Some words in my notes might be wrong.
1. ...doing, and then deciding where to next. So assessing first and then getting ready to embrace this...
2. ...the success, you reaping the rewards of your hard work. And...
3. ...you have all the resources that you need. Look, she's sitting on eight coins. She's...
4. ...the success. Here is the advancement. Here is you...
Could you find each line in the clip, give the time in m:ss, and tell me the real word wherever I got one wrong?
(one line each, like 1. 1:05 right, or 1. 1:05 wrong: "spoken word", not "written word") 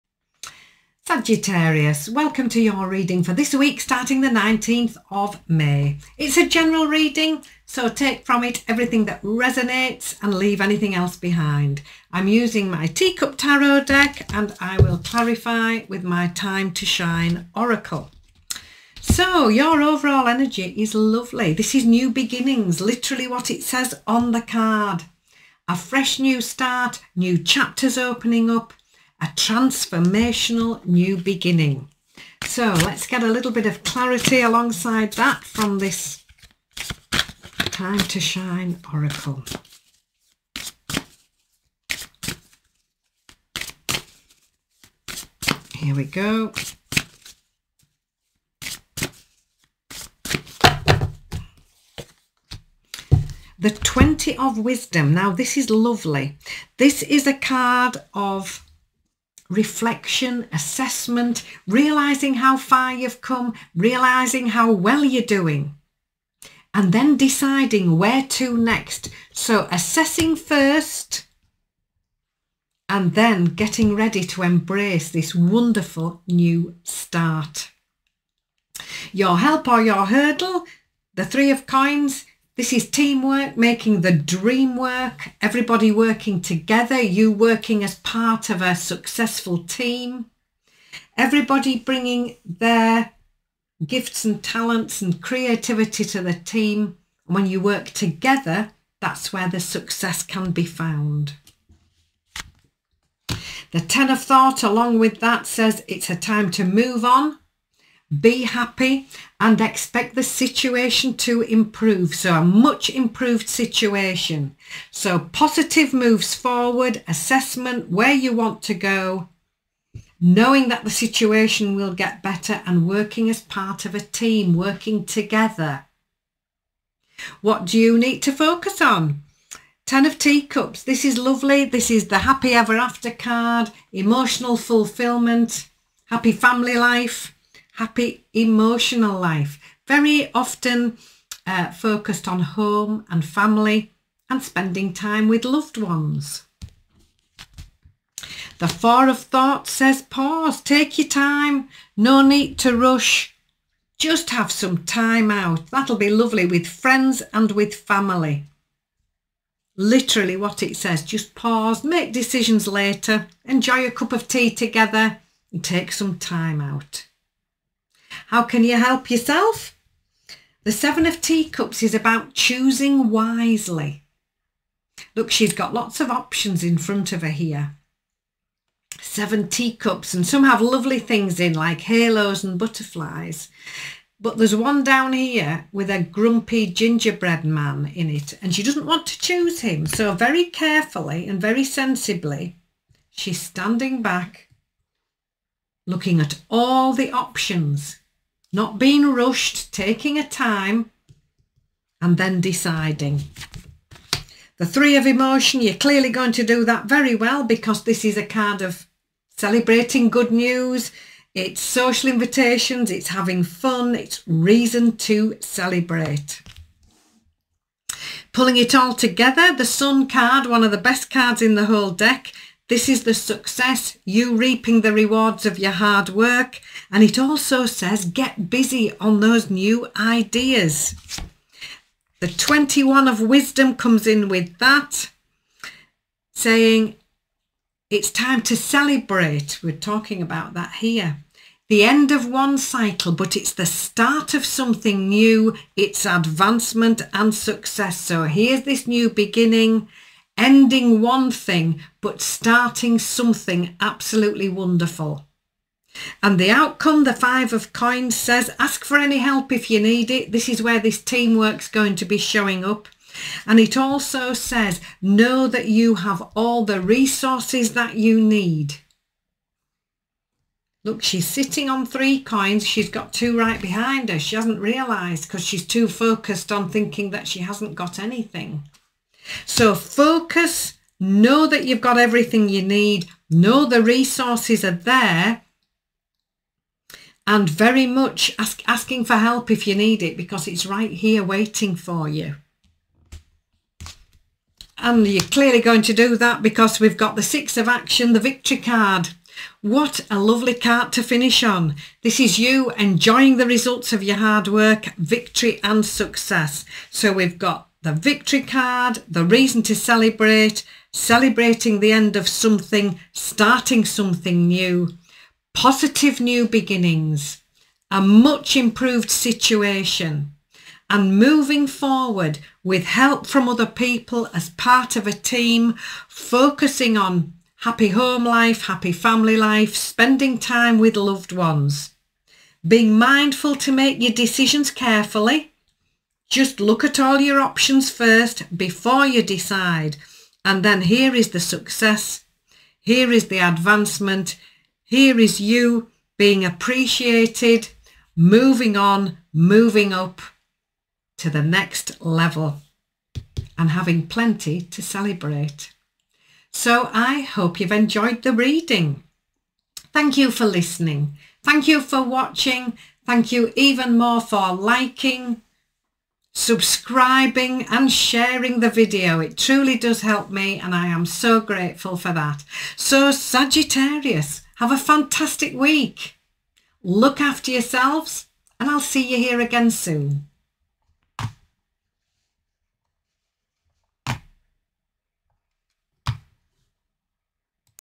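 1. 1:05 right
2. 3:43 right
3. 4:25 wrong: "three", not "eight"
4. 5:41 right.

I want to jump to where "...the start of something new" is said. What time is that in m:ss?
4:03.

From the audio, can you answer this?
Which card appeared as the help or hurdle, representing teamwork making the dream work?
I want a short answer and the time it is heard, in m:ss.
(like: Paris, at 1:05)
Three of Coins, at 1:21.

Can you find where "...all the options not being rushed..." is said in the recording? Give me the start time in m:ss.
3:16.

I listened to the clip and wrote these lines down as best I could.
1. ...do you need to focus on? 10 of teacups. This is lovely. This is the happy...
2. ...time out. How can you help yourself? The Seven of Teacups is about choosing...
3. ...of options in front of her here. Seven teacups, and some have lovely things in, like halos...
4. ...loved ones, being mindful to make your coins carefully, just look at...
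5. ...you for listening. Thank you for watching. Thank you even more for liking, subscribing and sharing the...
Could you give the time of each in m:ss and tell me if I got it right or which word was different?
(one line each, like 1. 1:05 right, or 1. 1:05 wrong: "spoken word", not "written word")
1. 2:07 right
2. 2:46 right
3. 2:55 right
4. 5:30 wrong: "decisions", not "coins"
5. 6:00 right.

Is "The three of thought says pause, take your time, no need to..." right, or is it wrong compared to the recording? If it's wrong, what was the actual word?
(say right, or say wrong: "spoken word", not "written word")
wrong: "four", not "three".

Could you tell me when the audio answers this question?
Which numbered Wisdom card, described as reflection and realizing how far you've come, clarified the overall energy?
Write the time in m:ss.
0:53.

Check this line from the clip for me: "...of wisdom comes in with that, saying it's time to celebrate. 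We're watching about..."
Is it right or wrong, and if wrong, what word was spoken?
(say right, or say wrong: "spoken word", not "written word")
wrong: "talking", not "watching".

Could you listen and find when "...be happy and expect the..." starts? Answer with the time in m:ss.
1:48.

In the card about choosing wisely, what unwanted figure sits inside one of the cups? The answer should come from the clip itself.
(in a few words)
grumpy gingerbread man.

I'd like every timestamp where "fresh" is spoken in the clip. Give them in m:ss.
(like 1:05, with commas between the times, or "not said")
0:25.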